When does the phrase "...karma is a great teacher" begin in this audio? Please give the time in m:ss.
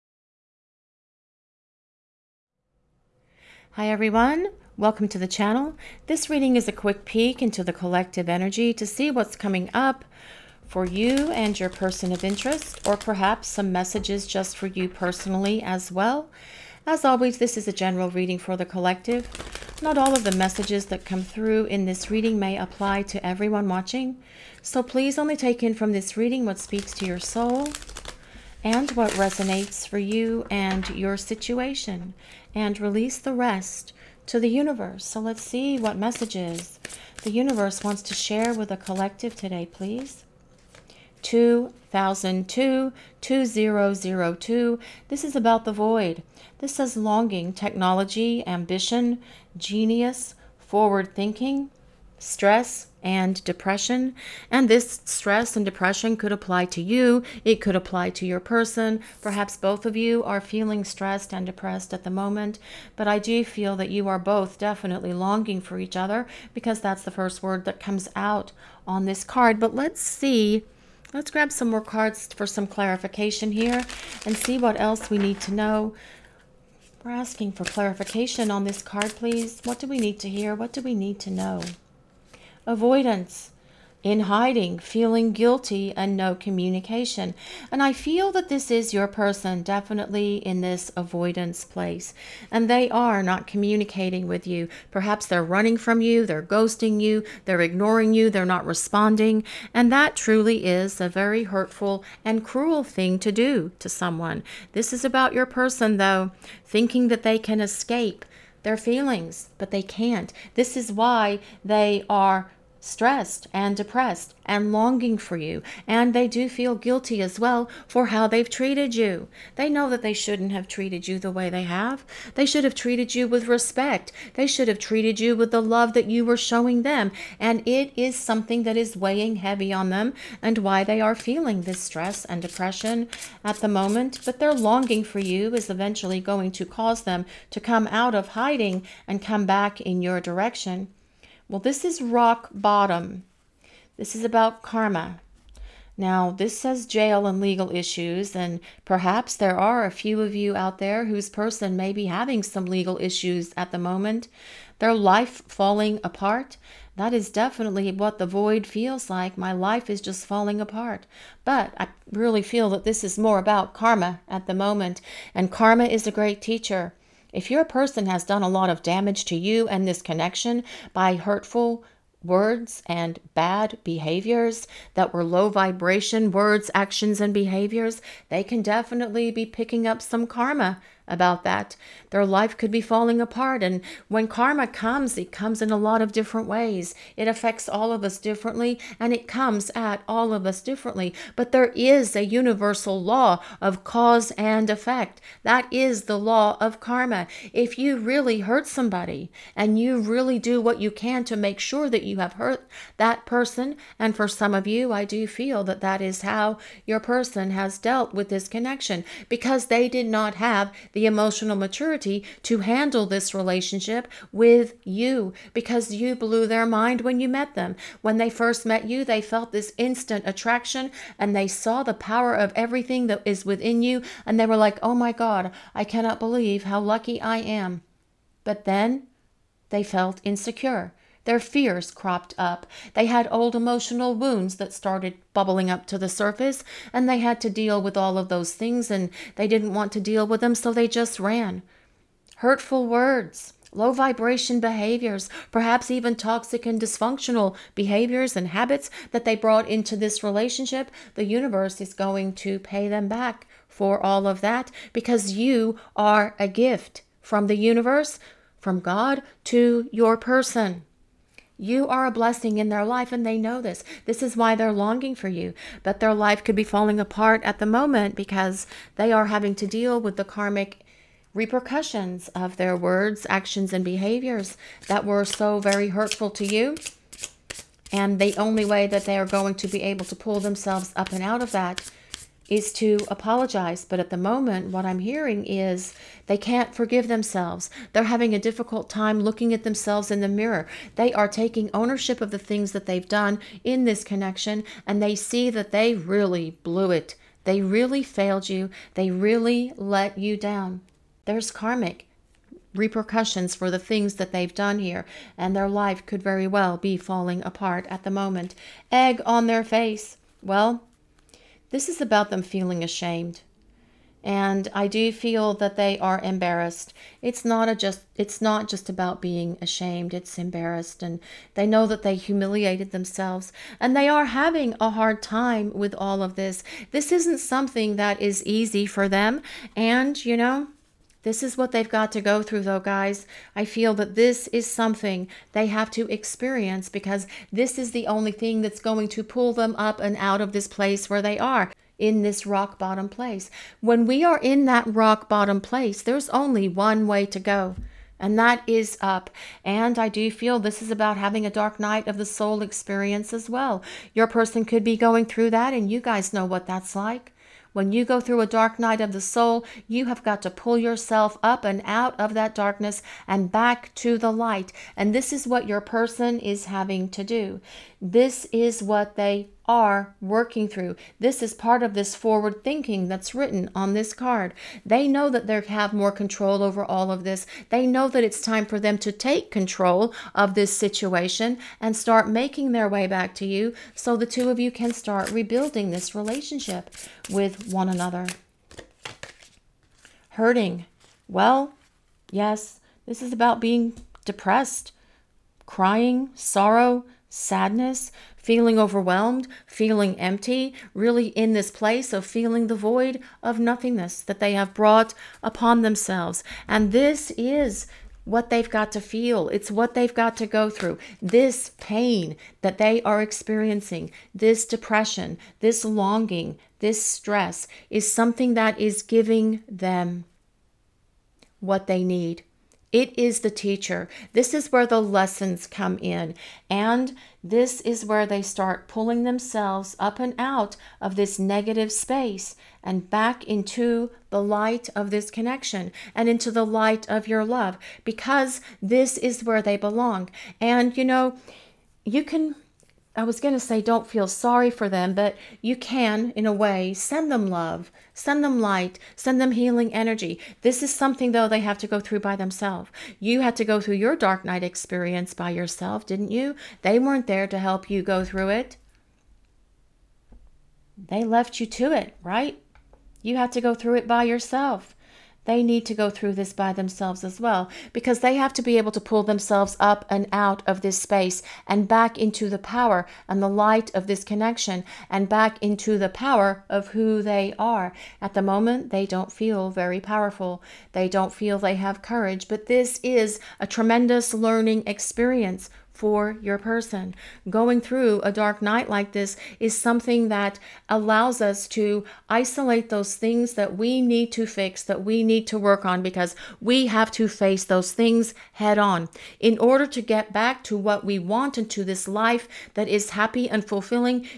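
2:45.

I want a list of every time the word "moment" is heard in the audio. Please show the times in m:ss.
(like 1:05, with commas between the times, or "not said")
1:02, 2:13, 2:33, 2:44, 4:27, 4:44, 5:08, 7:58.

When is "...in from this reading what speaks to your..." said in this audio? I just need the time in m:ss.
0:25.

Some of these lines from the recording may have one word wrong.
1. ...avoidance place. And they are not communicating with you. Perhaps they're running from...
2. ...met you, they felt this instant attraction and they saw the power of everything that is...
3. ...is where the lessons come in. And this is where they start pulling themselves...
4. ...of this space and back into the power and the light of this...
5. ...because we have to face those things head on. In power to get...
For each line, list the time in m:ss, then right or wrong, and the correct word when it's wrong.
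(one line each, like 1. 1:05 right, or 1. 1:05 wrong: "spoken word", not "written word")
1. 1:30 right
2. 3:38 right
3. 7:04 right
4. 7:50 right
5. 8:16 wrong: "order", not "power".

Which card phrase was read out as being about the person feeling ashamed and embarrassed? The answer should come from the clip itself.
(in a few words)
Egg on their face.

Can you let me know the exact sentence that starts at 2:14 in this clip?
But their longing for you is eventually going to cause them to come out of hiding and come back in your direction.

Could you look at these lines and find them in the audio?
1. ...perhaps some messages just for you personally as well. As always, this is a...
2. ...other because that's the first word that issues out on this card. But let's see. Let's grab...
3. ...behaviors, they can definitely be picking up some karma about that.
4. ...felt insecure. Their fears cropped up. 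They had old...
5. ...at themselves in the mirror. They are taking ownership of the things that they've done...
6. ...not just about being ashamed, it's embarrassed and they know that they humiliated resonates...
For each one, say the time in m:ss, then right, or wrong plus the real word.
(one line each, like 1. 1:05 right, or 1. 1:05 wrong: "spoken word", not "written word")
1. 0:12 right
2. 1:05 wrong: "comes", not "issues"
3. 2:57 right
4. 3:49 right
5. 4:49 right
6. 5:18 wrong: "themselves", not "resonates".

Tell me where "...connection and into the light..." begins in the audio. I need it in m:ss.
7:15.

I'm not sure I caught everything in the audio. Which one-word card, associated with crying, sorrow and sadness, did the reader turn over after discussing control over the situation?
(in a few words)
Hurting.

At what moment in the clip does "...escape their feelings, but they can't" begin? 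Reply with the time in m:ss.
1:47.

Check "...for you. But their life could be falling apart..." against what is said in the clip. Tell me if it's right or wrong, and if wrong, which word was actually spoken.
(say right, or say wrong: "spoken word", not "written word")
right.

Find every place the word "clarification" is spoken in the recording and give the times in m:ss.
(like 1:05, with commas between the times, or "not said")
1:12, 1:17.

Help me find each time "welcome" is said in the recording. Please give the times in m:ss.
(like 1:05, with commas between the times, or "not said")
0:04.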